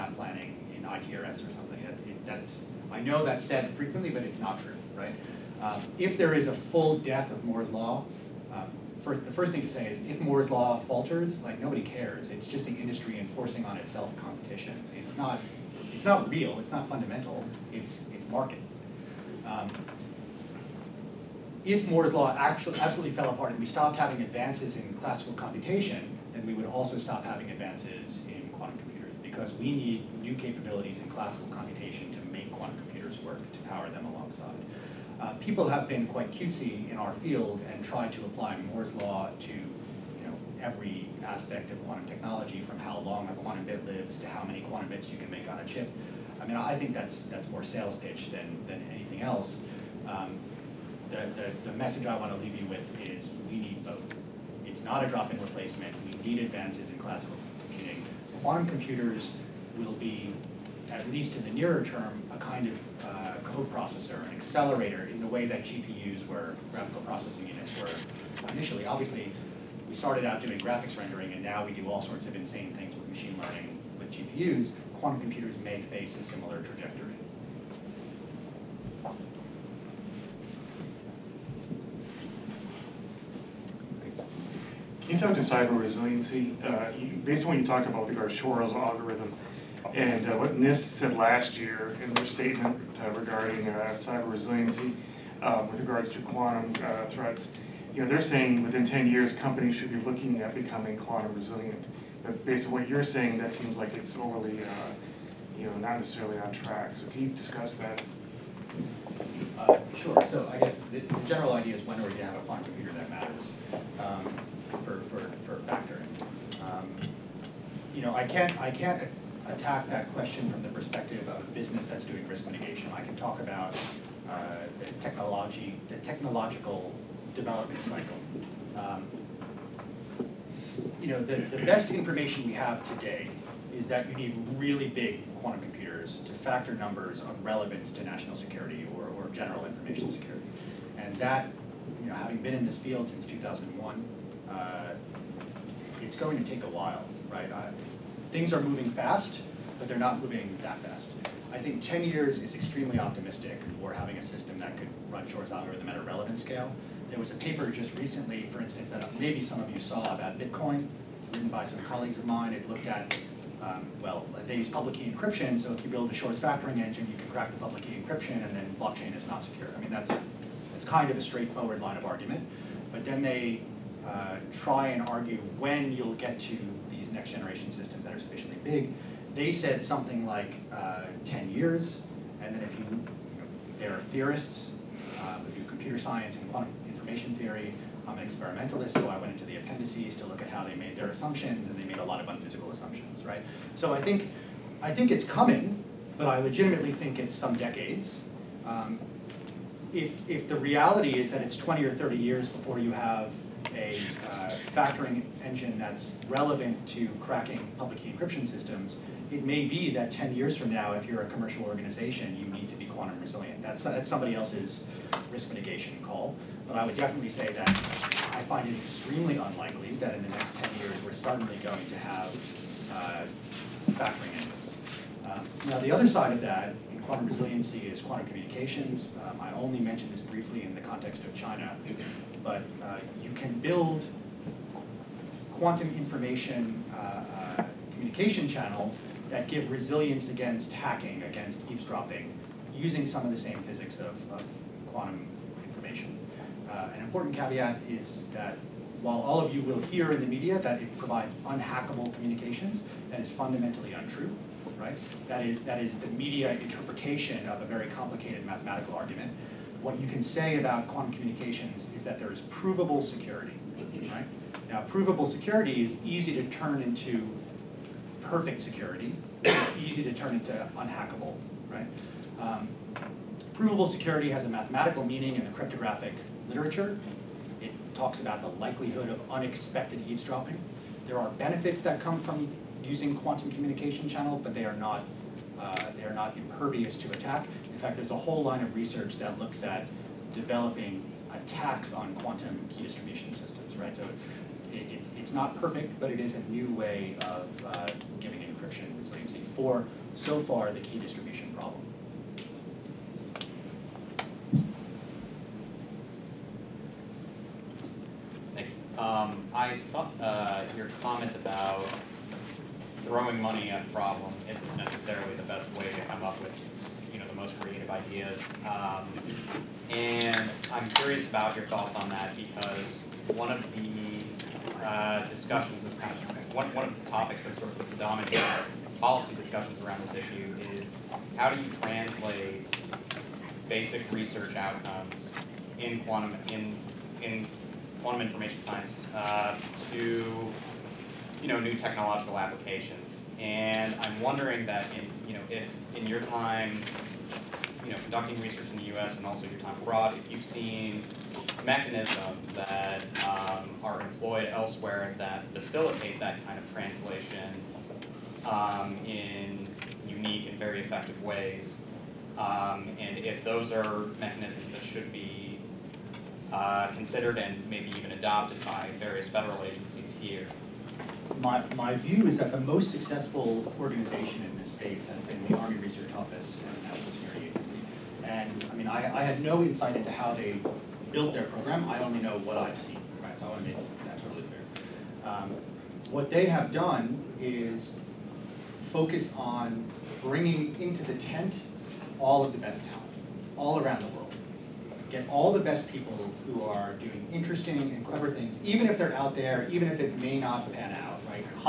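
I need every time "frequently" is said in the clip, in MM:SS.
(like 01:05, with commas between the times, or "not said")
00:03.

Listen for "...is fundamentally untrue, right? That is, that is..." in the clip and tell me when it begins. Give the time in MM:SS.
04:13.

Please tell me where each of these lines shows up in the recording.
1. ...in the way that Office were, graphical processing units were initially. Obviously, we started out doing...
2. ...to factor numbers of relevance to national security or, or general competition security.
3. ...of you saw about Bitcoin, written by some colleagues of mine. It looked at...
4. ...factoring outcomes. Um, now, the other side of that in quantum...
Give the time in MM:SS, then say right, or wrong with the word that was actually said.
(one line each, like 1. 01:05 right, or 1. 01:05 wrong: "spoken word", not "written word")
1. 01:05 wrong: "GPUs", not "Office"
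2. 02:16 wrong: "information", not "competition"
3. 02:39 right
4. 03:43 wrong: "engines", not "outcomes".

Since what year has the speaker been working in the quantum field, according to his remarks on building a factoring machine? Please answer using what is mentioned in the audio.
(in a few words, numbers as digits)
2001.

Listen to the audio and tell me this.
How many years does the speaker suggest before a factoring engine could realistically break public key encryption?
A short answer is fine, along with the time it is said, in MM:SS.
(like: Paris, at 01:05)
20 or 30 years, at 03:21.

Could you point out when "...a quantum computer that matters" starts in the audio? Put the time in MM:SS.
01:52.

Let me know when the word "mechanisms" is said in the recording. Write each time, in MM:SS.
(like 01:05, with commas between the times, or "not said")
05:51, 06:04.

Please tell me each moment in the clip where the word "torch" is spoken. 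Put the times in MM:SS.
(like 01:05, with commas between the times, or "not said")
not said.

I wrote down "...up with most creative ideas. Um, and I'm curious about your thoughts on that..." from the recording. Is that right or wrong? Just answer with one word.
right.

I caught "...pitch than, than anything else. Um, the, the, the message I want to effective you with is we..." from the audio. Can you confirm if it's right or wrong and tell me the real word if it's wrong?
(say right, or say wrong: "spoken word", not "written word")
wrong: "leave", not "effective".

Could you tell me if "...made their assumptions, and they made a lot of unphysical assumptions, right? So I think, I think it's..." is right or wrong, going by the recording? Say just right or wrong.
right.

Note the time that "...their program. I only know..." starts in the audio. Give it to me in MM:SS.
06:21.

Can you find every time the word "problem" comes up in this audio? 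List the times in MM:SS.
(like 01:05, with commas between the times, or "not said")
05:01, 05:13.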